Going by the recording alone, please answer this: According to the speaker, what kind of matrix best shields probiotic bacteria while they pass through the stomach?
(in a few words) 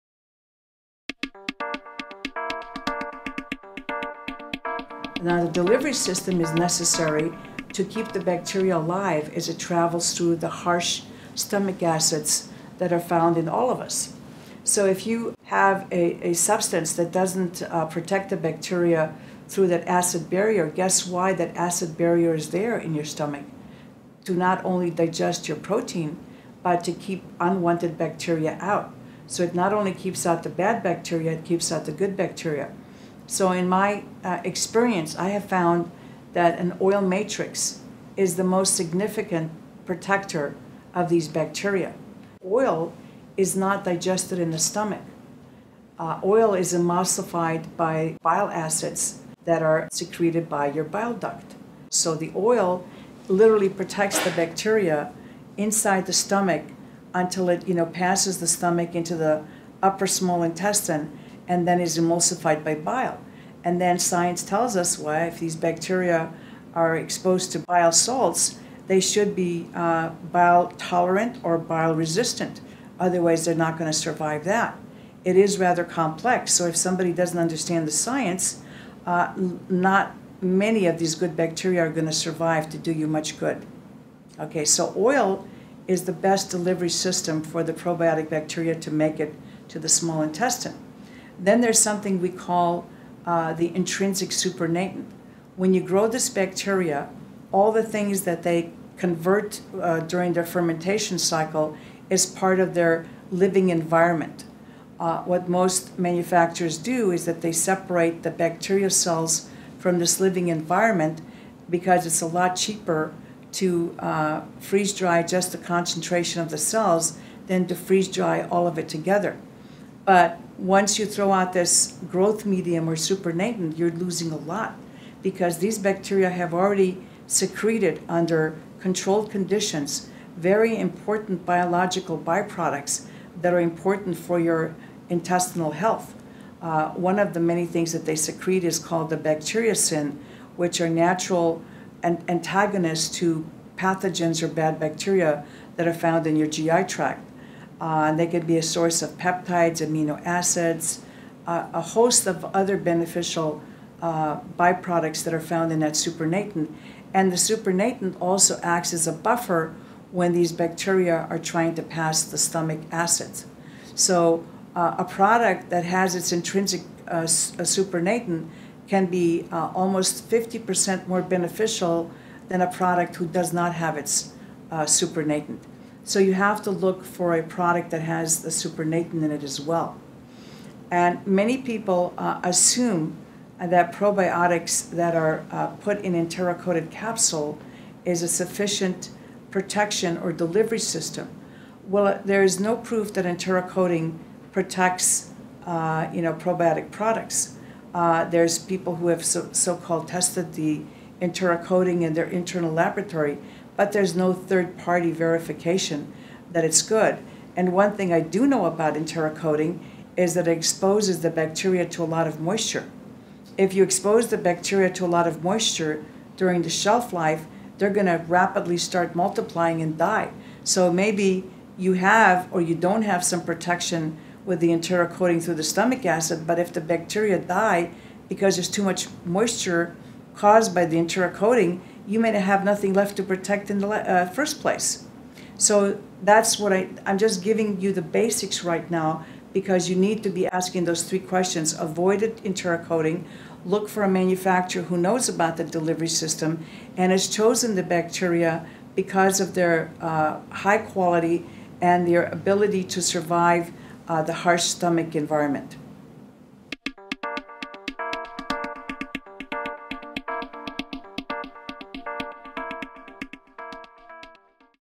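oil matrix.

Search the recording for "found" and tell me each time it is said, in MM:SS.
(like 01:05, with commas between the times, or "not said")
00:12, 00:35, 02:25, 02:35.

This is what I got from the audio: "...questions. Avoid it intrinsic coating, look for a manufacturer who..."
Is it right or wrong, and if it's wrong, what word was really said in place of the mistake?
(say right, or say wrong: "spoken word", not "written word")
wrong: "enteric", not "intrinsic".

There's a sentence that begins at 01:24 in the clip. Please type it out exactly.
Okay, so oil is the best delivery system for the probiotic bacteria to make it to the small intestine.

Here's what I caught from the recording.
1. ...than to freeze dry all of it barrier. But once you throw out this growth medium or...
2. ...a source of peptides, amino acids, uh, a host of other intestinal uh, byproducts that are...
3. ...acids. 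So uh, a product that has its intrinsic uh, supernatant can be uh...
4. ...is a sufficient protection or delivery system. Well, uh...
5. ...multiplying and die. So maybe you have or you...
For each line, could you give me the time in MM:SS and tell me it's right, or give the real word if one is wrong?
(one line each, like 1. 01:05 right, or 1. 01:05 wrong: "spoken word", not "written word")
1. 01:57 wrong: "together", not "barrier"
2. 02:28 wrong: "beneficial", not "intestinal"
3. 02:42 right
4. 03:08 right
5. 03:39 right.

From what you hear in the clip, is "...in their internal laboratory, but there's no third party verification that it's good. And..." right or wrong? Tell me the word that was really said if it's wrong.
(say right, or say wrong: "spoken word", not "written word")
right.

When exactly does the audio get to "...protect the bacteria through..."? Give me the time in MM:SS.
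00:17.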